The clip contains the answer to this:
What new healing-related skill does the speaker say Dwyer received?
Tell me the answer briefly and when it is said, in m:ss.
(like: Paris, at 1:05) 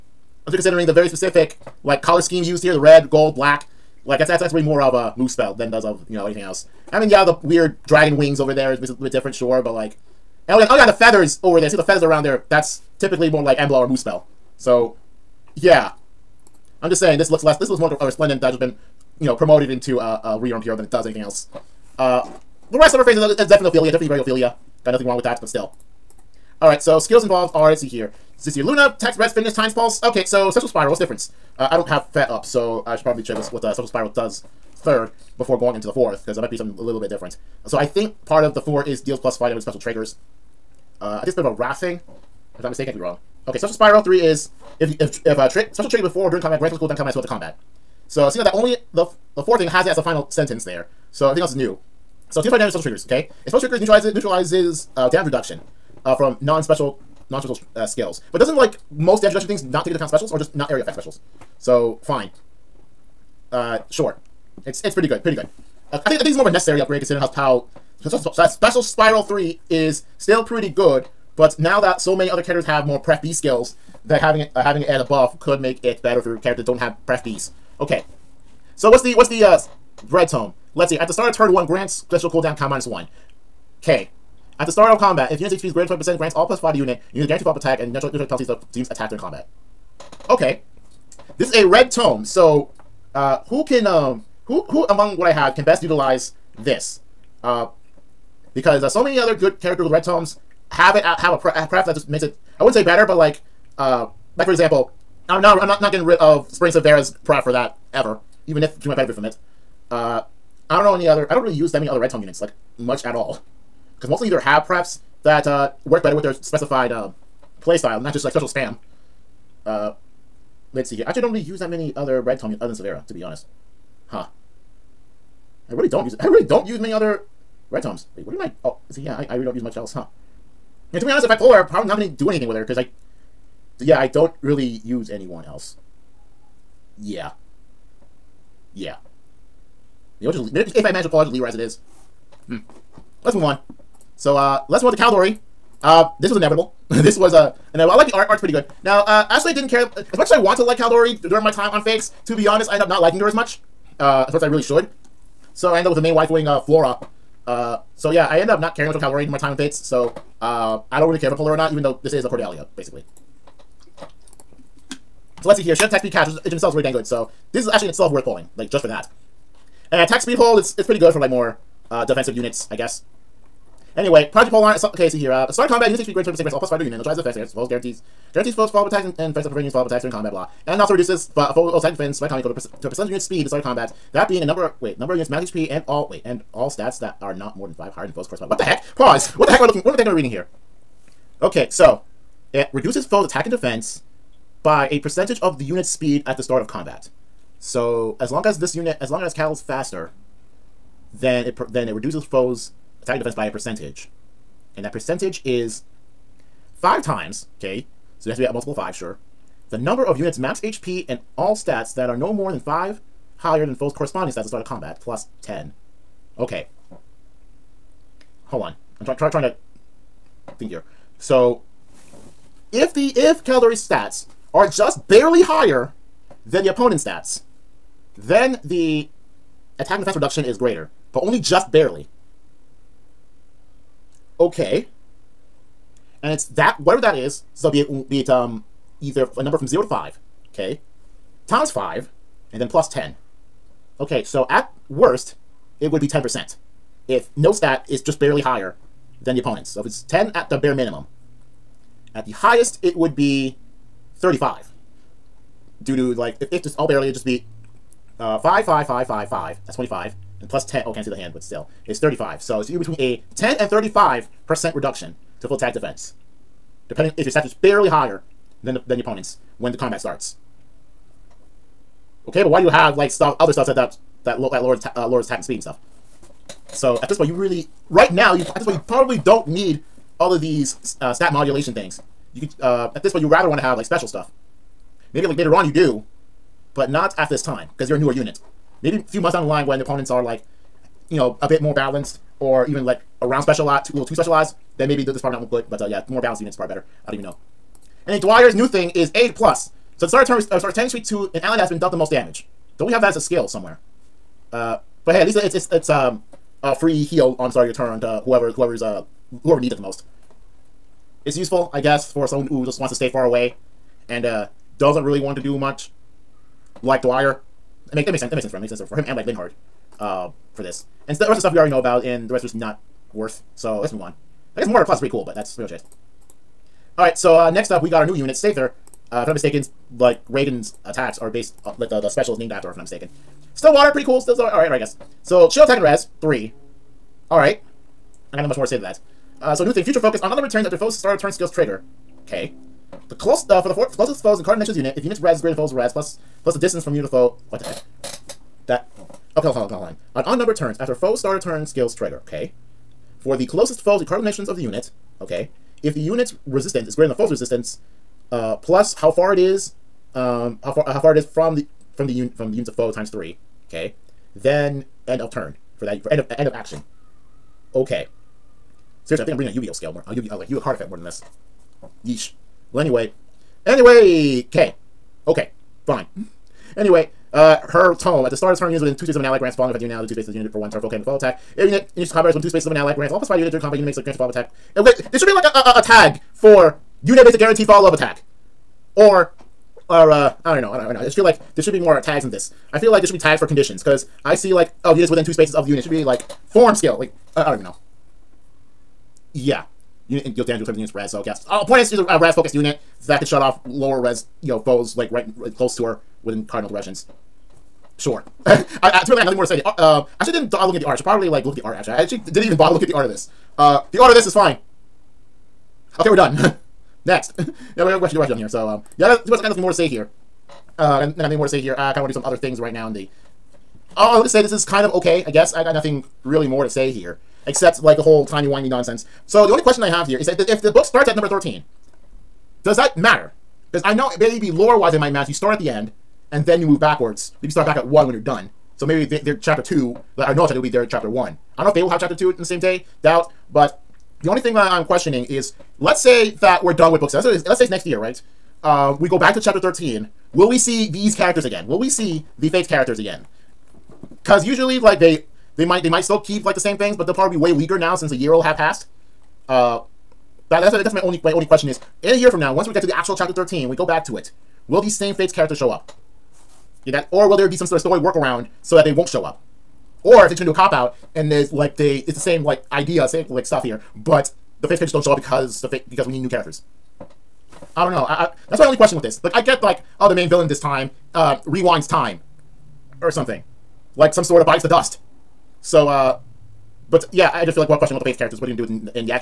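Aid Plus, at 4:59.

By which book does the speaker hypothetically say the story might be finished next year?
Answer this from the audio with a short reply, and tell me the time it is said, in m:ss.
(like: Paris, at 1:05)
book seven, at 7:27.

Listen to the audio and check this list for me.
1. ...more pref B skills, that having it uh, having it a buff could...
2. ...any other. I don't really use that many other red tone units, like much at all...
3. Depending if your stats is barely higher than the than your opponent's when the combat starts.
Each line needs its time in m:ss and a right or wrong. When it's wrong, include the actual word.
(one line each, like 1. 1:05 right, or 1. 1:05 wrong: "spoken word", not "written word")
1. 1:12 right
2. 1:50 right
3. 4:26 right.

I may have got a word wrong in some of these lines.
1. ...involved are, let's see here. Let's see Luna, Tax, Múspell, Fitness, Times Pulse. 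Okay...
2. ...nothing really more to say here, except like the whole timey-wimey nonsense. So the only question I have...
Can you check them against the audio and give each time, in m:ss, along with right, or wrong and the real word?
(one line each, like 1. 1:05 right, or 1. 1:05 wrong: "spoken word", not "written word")
1. 0:27 wrong: "Res", not "Múspell"
2. 7:05 right.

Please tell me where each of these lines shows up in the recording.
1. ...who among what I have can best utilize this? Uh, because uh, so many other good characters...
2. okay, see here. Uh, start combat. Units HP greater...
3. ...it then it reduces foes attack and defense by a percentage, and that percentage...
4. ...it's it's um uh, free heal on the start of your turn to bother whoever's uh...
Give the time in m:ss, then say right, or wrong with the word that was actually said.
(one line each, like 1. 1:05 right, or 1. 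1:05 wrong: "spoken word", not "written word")
1. 1:34 right
2. 2:54 right
3. 3:21 right
4. 5:05 wrong: "whoever", not "bother".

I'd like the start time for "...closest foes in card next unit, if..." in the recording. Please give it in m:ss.
5:43.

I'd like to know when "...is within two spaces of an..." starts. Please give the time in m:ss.
6:22.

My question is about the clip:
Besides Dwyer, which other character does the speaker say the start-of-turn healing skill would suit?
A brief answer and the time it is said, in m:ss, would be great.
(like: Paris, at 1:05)
Linhardt, at 5:19.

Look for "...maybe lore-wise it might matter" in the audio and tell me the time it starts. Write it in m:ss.
7:14.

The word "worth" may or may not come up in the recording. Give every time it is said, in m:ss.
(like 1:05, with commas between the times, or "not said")
2:48, 5:23.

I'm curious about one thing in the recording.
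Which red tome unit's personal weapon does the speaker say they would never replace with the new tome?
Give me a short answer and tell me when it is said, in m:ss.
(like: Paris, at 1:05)
Spring Severa, at 1:46.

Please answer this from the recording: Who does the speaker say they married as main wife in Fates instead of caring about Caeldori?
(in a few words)
Flora.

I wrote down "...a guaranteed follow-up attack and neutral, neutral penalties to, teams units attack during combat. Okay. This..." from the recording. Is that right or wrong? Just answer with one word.
right.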